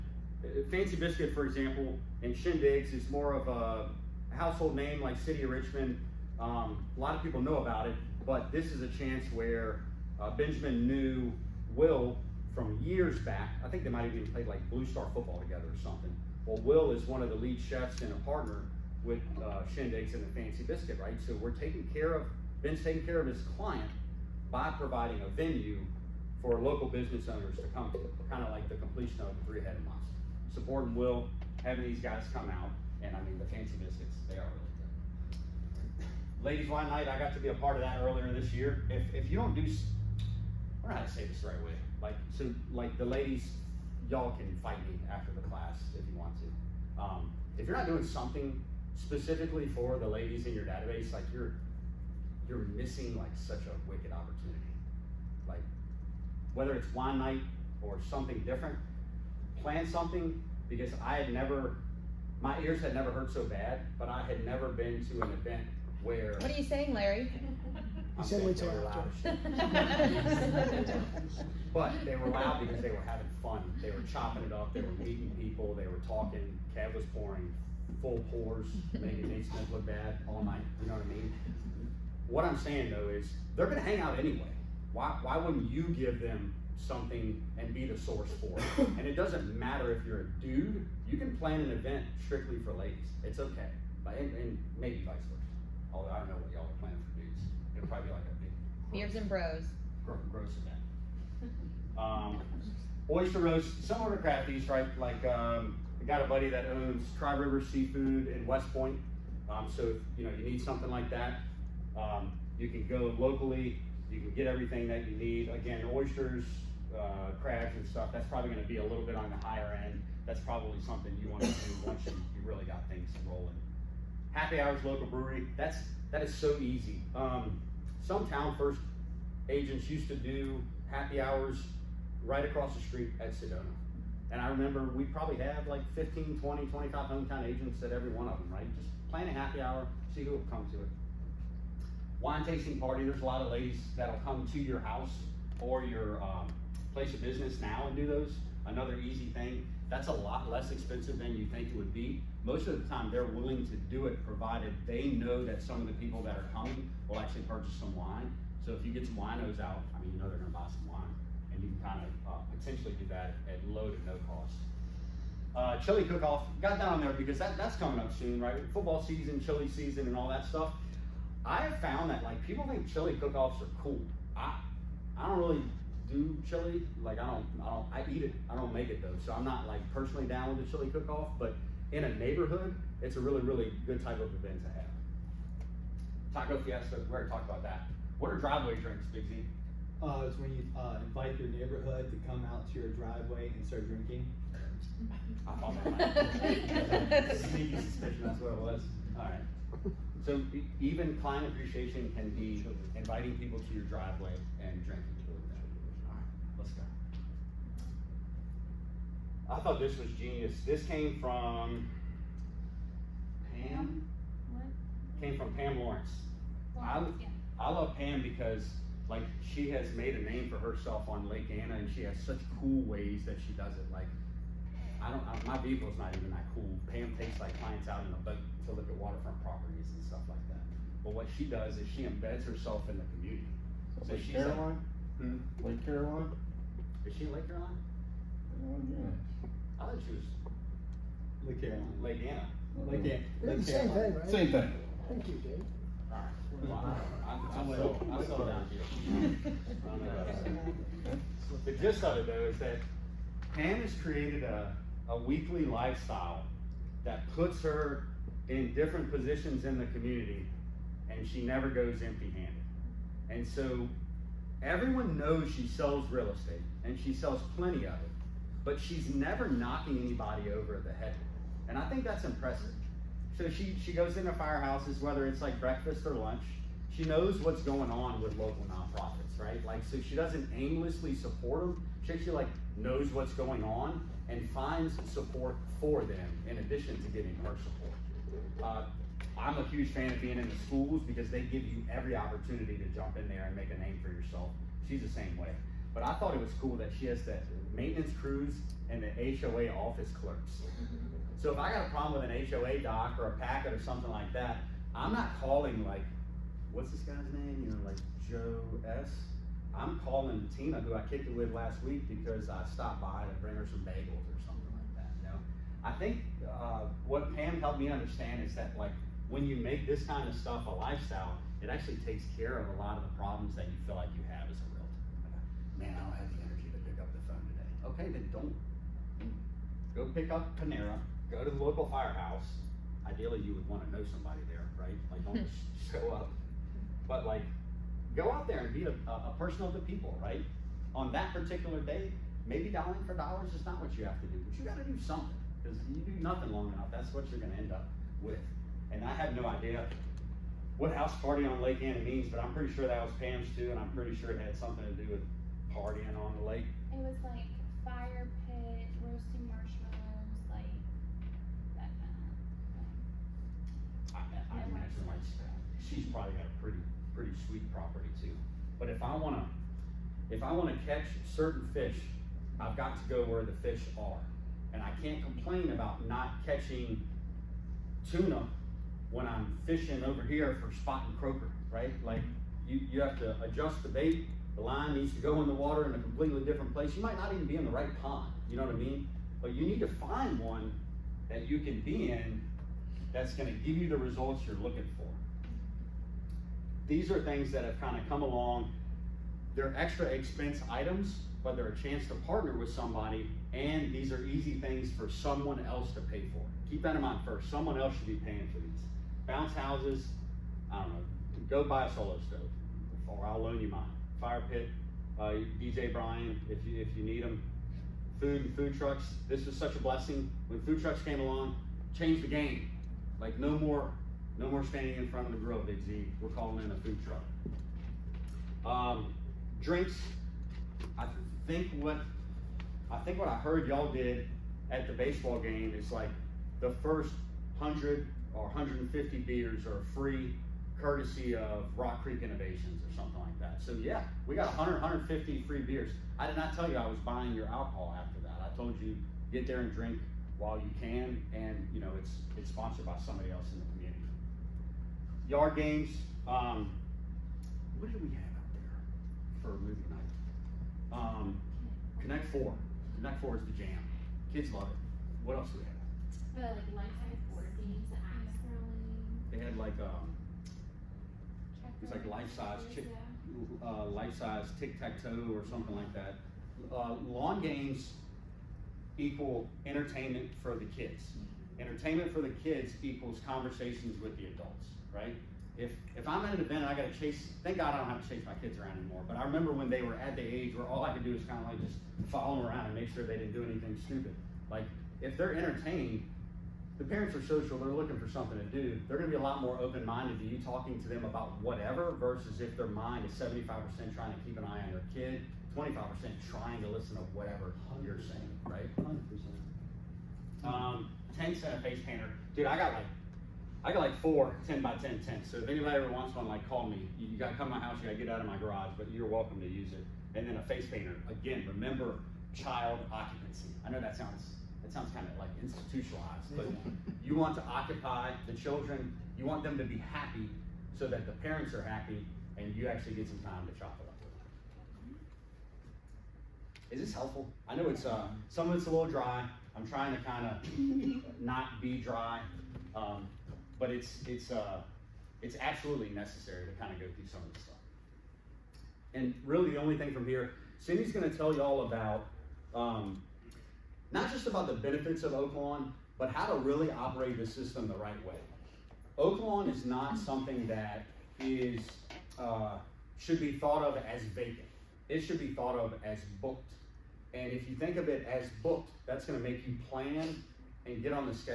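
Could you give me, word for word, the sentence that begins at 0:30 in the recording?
Supporting Will, having these guys come out, and I mean the fancy biscuits, they are really good.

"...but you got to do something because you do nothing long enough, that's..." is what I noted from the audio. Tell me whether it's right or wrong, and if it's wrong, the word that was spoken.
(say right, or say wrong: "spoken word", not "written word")
right.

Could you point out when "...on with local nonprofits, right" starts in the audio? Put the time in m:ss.
4:37.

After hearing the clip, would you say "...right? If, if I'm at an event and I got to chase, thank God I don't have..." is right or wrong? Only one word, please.
right.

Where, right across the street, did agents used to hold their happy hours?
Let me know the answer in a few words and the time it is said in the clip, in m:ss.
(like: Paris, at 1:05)
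Sedona, at 2:13.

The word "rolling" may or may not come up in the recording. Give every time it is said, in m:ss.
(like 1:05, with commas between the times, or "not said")
2:03, 7:48.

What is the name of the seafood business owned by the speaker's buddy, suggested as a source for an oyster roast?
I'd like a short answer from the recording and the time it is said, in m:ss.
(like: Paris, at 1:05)
Tri River Seafood, at 1:47.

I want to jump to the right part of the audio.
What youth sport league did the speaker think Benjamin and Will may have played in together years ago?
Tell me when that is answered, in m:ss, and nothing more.
0:14.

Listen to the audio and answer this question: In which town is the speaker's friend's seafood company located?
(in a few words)
West Point.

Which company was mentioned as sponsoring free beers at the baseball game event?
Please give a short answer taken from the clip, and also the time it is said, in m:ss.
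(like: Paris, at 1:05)
Rock Creek Innovations, at 7:21.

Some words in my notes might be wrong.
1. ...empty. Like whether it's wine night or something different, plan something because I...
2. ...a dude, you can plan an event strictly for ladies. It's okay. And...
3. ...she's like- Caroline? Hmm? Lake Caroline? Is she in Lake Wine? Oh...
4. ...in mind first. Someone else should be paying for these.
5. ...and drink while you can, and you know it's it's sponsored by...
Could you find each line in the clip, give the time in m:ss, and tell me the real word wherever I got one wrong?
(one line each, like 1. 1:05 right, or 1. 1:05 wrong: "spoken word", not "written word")
1. 0:54 wrong: "opportunity", not "empty"
2. 1:30 right
3. 3:54 wrong: "Caroline", not "Wine"
4. 6:46 right
5. 7:29 right.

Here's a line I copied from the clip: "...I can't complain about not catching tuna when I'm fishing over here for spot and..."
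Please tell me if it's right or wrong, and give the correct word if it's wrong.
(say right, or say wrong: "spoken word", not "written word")
right.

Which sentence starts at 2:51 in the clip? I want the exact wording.
I have found that like people think chili cook-offs are cool.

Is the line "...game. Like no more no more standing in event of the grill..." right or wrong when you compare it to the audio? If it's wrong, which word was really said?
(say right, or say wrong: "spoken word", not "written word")
wrong: "front", not "event".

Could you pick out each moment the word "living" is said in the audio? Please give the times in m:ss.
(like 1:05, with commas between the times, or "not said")
not said.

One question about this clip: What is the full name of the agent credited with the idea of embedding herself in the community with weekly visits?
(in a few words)
Pam Lawrence.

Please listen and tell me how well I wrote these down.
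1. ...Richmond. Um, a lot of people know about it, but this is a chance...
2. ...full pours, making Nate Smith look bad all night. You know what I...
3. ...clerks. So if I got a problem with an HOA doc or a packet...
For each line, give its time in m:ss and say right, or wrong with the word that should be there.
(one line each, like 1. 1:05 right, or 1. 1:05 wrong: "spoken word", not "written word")
1. 0:05 right
2. 1:18 right
3. 5:00 right.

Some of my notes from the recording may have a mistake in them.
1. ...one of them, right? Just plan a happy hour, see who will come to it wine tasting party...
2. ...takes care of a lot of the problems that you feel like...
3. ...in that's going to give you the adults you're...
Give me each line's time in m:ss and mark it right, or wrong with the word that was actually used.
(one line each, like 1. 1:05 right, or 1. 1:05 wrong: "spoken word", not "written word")
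1. 2:18 right
2. 5:22 right
3. 6:32 wrong: "results", not "adults".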